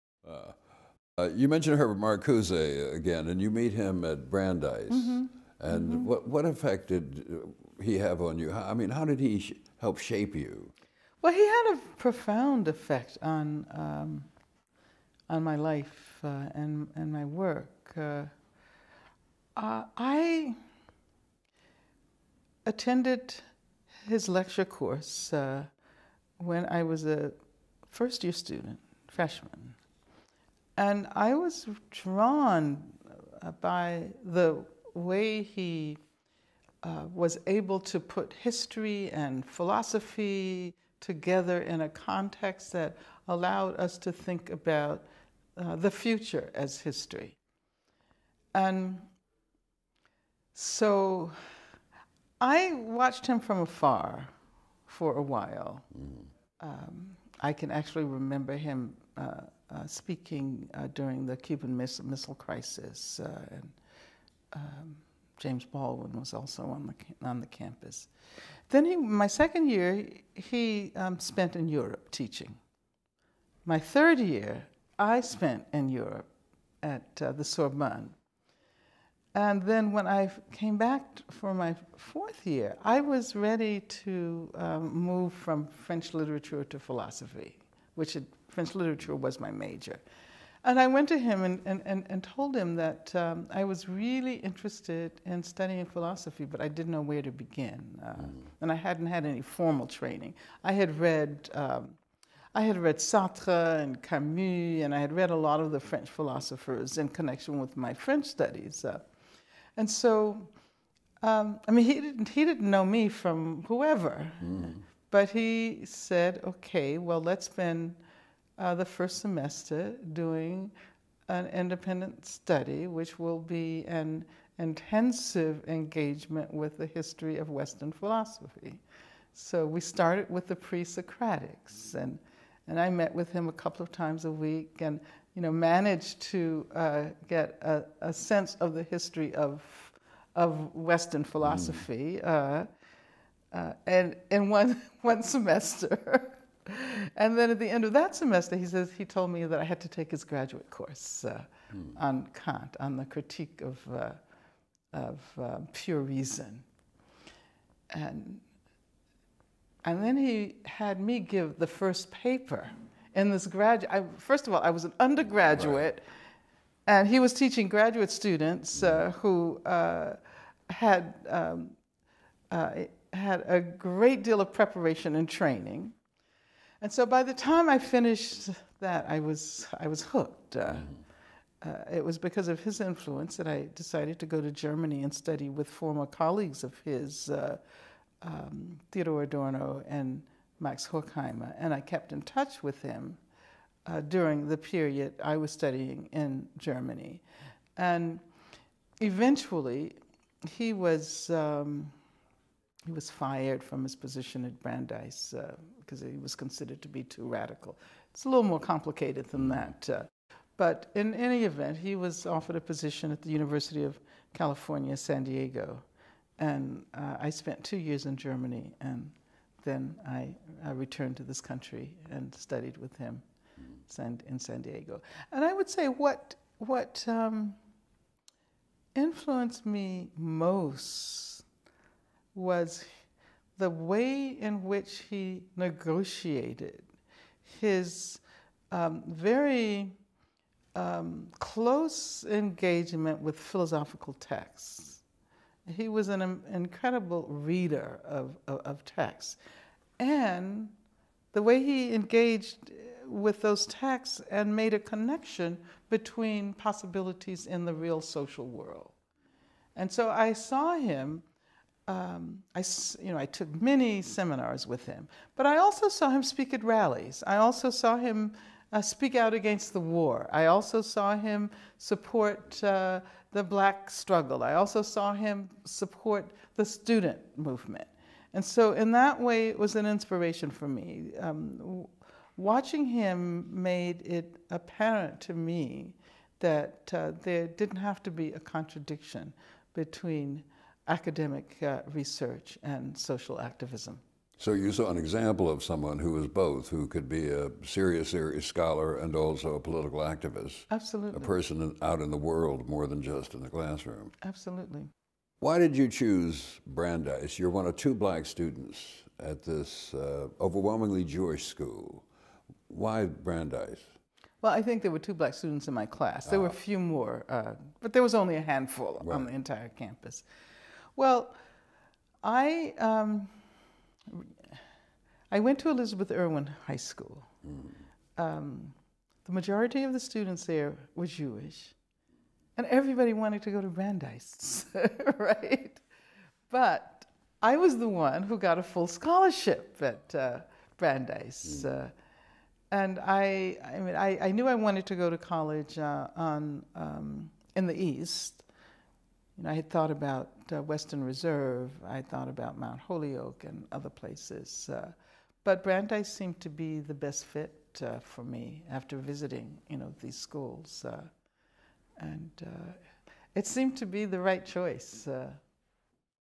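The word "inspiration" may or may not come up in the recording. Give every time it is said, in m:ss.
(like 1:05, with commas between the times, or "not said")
4:39.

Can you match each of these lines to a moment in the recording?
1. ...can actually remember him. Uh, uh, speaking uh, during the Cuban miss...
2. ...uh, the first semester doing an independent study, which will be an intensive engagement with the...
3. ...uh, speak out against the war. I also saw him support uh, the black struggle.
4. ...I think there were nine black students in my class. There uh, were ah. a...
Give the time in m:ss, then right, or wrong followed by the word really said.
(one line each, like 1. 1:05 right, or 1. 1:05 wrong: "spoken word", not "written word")
1. 0:57 right
2. 1:58 right
3. 4:28 right
4. 5:14 wrong: "two", not "nine".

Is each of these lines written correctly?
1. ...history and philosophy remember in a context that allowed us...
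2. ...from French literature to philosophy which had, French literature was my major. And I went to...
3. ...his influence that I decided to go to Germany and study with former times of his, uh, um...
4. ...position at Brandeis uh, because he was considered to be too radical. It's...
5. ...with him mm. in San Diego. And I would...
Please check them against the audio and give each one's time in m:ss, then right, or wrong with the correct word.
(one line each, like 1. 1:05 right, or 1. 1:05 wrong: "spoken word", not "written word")
1. 0:38 wrong: "together", not "remember"
2. 1:25 right
3. 3:02 wrong: "colleagues", not "times"
4. 3:23 right
5. 3:42 right.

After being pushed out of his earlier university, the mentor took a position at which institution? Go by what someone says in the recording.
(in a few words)
University of California, San Diego.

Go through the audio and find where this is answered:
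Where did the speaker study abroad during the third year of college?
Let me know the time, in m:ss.
1:17.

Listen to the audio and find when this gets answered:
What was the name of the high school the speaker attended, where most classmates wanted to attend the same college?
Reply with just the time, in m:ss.
5:25.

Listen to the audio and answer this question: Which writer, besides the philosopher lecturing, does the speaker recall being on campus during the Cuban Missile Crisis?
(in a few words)
James Baldwin.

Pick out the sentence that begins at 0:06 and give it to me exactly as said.
what, what effect did uh, he have on you?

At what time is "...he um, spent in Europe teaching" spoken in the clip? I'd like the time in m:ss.
1:10.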